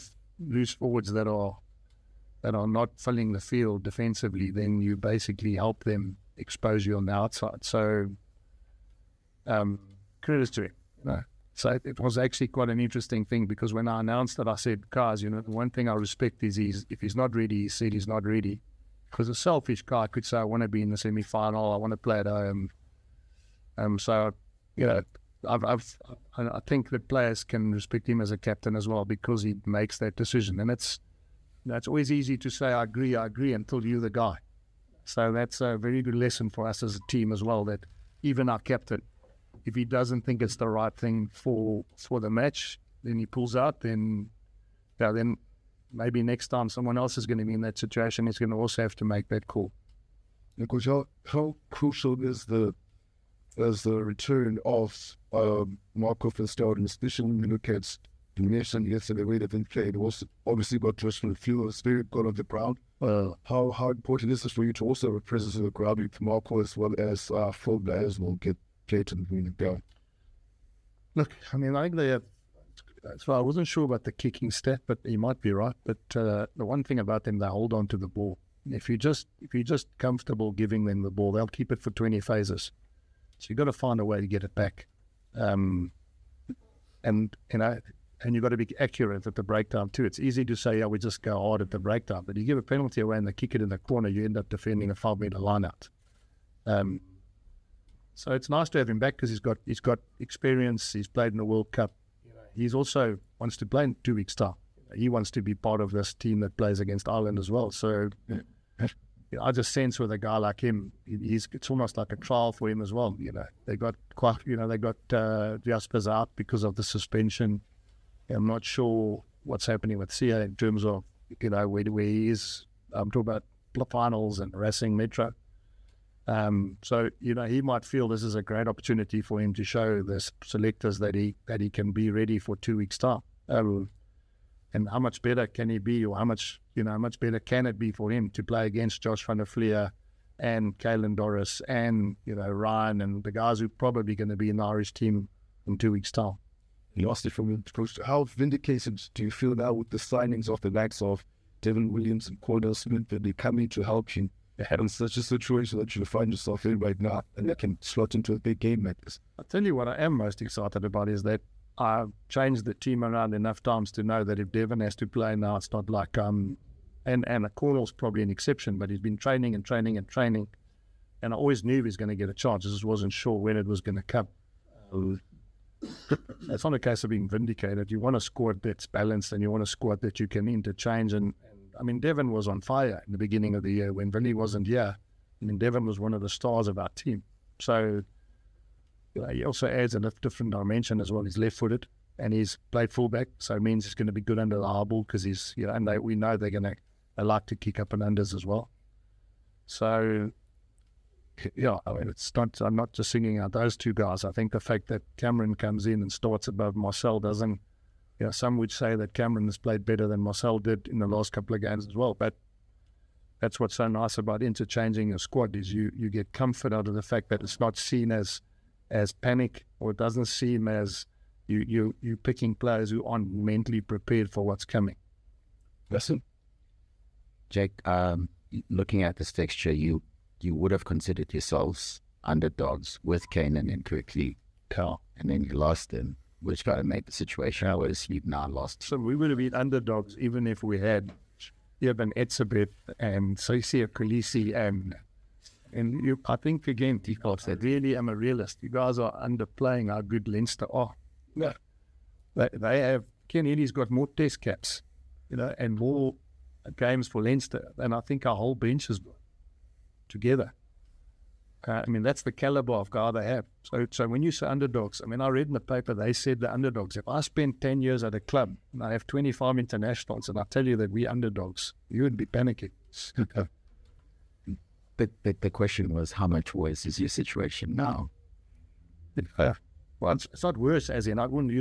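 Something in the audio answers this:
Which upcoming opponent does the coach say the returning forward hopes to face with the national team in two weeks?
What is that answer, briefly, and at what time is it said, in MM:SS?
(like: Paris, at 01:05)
Ireland, at 01:47.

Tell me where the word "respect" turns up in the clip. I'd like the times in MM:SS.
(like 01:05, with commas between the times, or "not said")
00:15, 00:27.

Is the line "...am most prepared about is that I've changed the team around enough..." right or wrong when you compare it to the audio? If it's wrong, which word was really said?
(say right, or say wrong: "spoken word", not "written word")
wrong: "excited", not "prepared".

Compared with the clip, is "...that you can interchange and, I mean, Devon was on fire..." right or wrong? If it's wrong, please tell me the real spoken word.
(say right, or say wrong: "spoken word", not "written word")
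right.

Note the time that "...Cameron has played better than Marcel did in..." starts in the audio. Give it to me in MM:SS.
03:29.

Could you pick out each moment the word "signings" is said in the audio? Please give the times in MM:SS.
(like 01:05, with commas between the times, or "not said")
02:29.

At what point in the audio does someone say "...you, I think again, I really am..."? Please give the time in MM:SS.
04:06.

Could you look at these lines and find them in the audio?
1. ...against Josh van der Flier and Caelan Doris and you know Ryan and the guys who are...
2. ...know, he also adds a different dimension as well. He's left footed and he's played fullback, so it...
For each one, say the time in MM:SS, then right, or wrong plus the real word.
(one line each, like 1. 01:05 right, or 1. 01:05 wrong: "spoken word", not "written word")
1. 02:18 right
2. 03:09 right.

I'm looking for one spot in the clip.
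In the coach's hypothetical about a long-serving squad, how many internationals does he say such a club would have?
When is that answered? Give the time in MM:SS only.
04:29.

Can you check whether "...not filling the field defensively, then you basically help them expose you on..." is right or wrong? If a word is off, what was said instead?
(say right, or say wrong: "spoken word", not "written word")
right.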